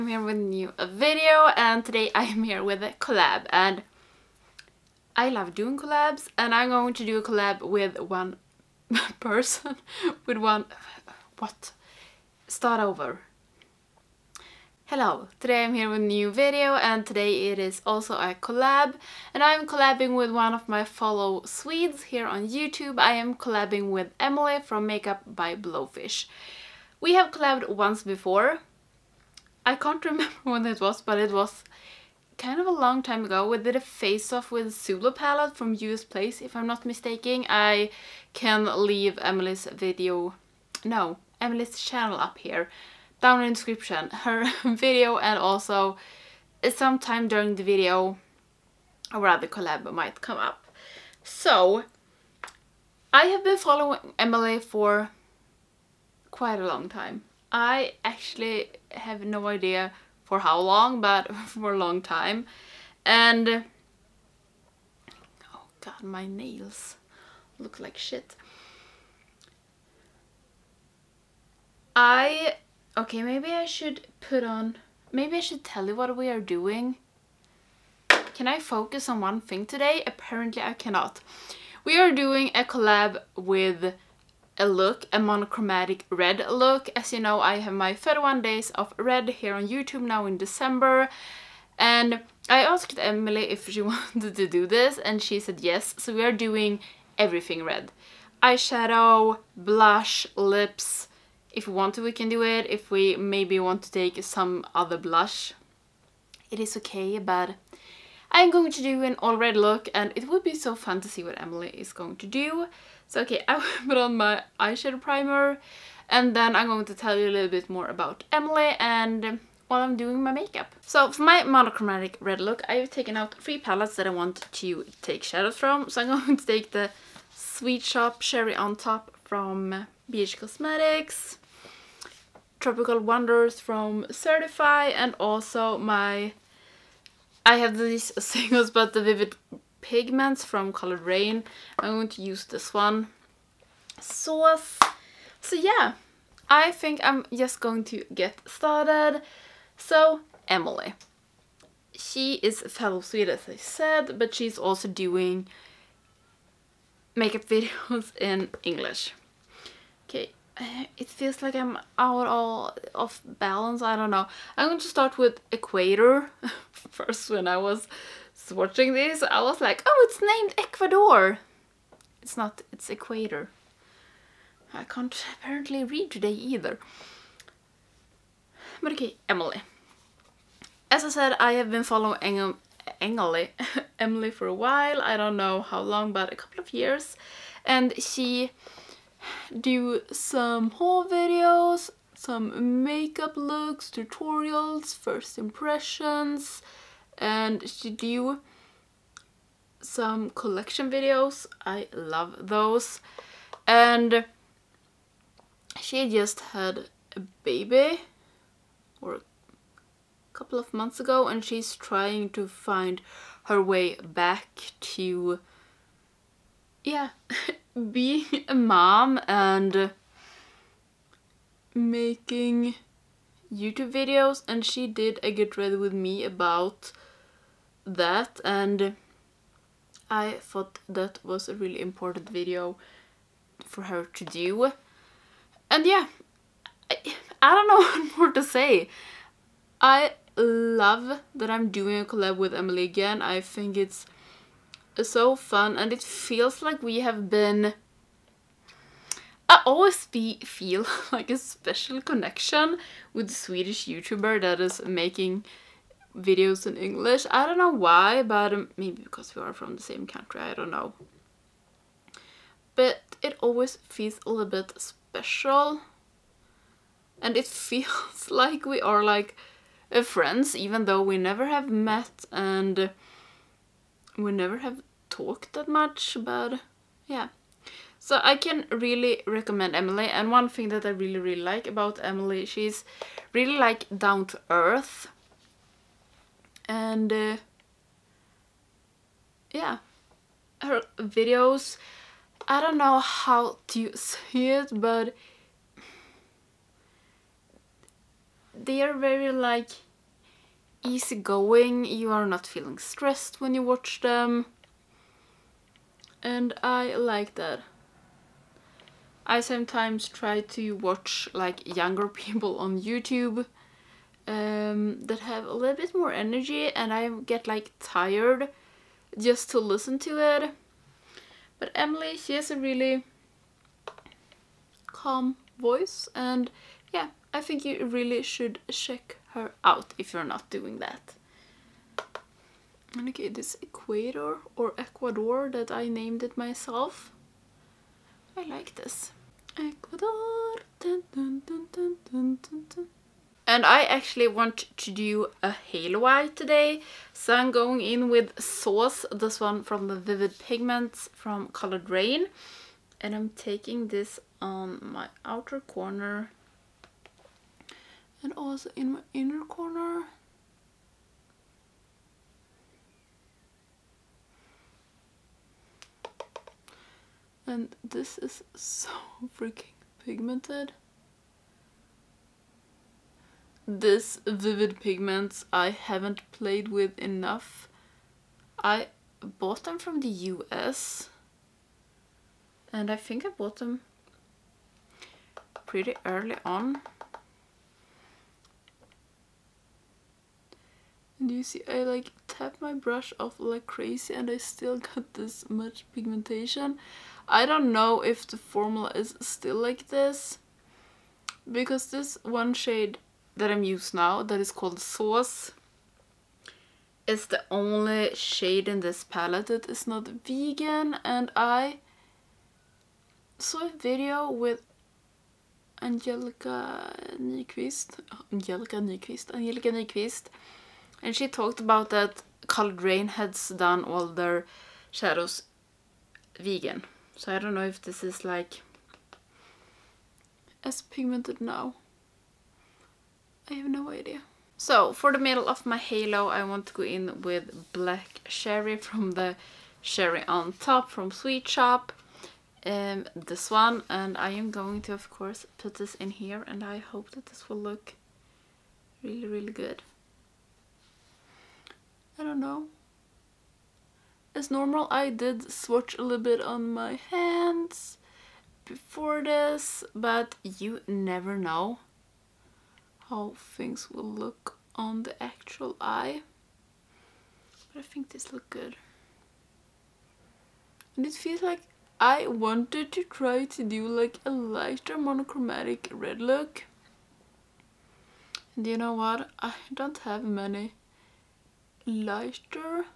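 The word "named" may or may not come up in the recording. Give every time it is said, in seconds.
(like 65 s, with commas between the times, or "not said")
170 s, 335 s.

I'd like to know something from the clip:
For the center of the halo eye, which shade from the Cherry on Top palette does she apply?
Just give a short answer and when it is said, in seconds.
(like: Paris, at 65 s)
Black Cherry, at 437 s.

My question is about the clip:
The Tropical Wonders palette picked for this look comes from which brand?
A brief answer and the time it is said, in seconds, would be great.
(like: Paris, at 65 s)
Certifeye, at 134 s.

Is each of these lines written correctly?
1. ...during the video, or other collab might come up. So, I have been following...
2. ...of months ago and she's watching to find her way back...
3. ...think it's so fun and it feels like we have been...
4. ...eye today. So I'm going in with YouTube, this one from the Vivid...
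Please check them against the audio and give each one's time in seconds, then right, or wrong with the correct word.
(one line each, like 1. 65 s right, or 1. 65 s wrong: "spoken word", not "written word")
1. 47 s right
2. 210 s wrong: "trying", not "watching"
3. 243 s right
4. 346 s wrong: "Sauce", not "YouTube".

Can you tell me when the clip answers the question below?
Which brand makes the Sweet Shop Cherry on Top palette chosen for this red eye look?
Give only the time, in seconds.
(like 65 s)
130 s.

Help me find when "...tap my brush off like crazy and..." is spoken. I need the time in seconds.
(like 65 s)
392 s.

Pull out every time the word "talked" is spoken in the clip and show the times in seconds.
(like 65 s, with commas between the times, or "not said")
275 s, 421 s.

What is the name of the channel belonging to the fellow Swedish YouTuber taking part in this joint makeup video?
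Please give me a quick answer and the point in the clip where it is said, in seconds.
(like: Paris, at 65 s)
Makeup by Blowfish, at 24 s.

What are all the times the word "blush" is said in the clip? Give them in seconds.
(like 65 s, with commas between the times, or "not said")
99 s, 104 s.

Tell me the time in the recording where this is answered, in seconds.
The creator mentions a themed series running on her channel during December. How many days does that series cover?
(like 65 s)
87 s.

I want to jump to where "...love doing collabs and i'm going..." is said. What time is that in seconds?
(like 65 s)
5 s.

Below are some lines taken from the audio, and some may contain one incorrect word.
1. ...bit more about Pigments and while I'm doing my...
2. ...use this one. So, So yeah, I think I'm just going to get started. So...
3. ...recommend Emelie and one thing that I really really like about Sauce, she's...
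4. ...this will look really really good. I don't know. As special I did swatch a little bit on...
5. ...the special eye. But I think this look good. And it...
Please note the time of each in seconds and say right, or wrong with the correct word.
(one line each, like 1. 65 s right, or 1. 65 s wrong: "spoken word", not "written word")
1. 117 s wrong: "Emelie", not "Pigments"
2. 142 s right
3. 279 s wrong: "Emelie", not "Sauce"
4. 447 s wrong: "normal", not "special"
5. 465 s wrong: "actual", not "special".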